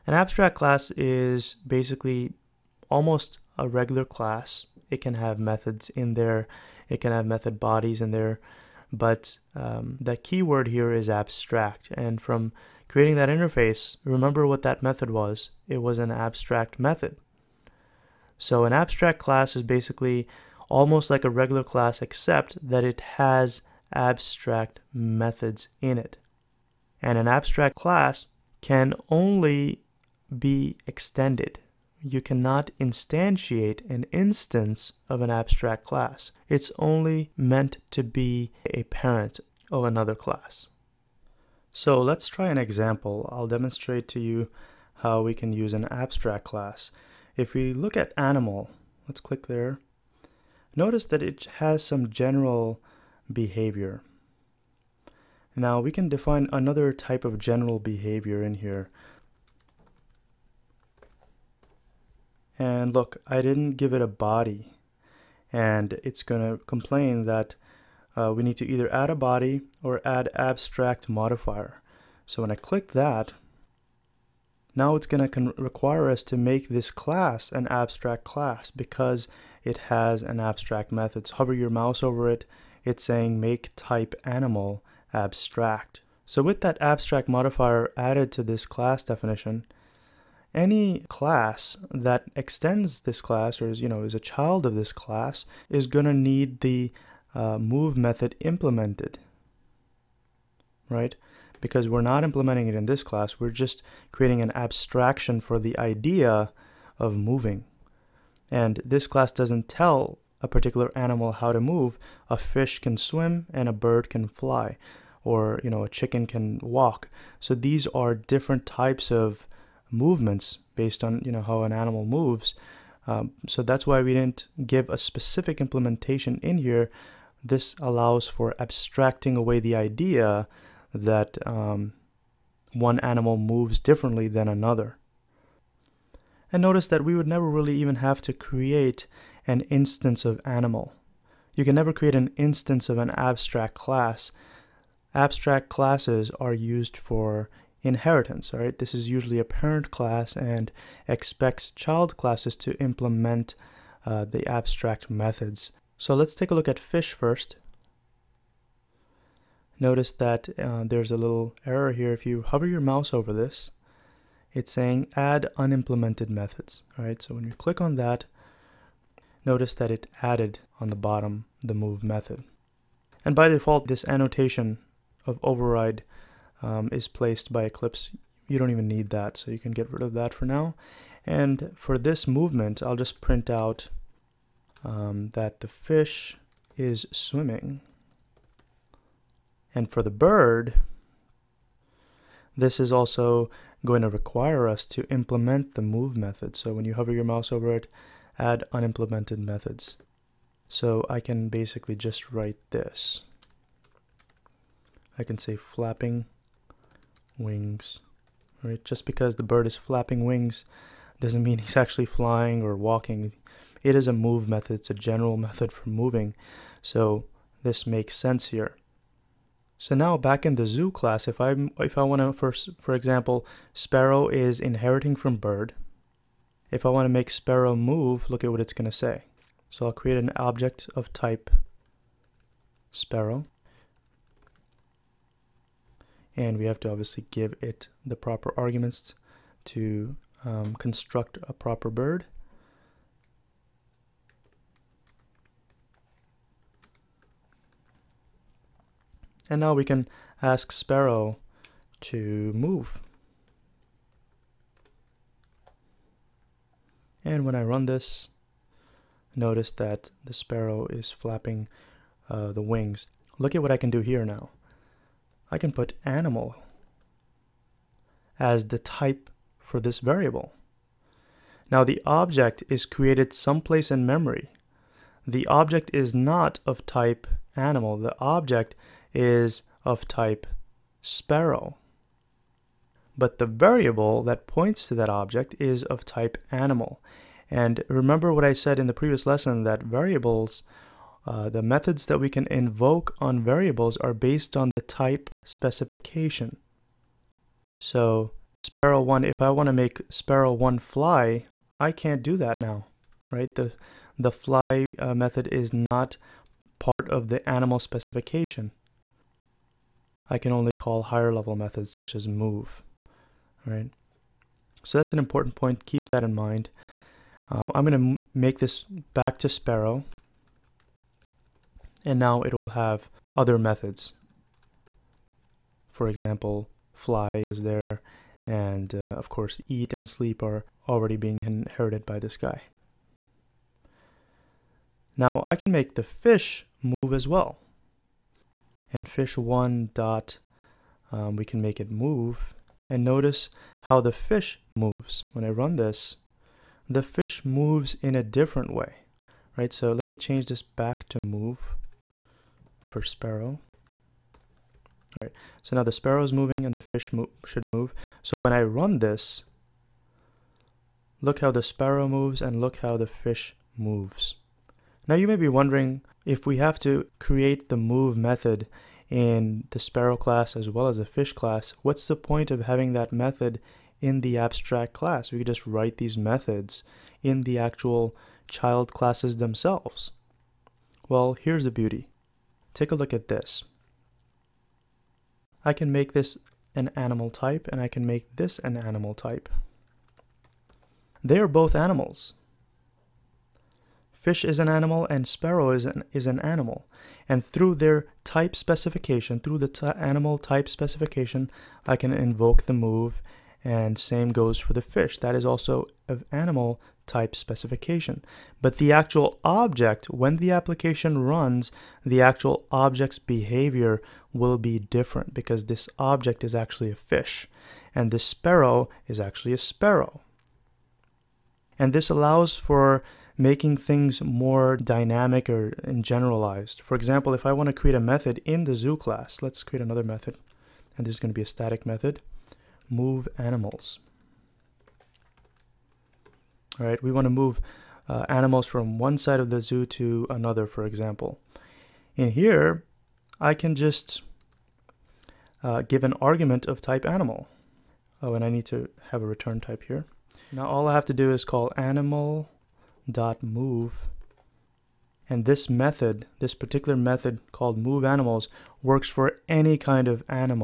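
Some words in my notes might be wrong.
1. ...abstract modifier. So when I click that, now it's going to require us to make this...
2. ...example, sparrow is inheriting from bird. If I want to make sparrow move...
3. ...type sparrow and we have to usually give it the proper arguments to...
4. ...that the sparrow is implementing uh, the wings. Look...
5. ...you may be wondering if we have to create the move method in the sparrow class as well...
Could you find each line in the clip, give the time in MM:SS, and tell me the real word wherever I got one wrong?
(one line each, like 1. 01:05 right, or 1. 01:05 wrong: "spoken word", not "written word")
1. 01:10 right
2. 03:42 right
3. 03:51 wrong: "obviously", not "usually"
4. 04:19 wrong: "flapping", not "implementing"
5. 06:05 right.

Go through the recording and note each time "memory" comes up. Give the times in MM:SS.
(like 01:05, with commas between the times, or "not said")
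04:34.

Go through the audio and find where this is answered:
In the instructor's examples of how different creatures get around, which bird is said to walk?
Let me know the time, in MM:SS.
01:55.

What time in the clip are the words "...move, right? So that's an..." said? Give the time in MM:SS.
05:12.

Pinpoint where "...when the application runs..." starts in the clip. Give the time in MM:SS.
06:50.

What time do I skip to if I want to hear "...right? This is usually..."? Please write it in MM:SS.
02:28.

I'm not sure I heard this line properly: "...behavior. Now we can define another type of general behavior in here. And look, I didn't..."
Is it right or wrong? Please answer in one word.
right.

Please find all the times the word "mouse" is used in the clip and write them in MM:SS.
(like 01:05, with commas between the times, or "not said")
01:21, 02:42, 03:17.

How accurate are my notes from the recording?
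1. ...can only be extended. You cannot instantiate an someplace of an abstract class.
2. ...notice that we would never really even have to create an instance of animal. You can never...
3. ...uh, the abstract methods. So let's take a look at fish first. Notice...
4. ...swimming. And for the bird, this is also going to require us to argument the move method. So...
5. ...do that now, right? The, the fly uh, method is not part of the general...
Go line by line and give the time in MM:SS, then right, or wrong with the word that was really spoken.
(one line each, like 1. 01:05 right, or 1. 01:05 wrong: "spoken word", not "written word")
1. 00:28 wrong: "instance", not "someplace"
2. 02:16 right
3. 02:34 right
4. 03:07 wrong: "implement", not "argument"
5. 05:02 wrong: "animal", not "general".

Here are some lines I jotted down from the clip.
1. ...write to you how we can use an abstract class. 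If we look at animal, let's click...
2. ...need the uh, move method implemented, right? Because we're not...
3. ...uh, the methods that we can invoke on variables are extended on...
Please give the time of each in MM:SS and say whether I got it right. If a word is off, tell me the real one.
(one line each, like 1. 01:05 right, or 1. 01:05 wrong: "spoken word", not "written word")
1. 00:43 wrong: "demonstrate", not "write"
2. 01:36 right
3. 04:51 wrong: "based", not "extended".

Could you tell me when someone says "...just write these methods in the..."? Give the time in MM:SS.
06:15.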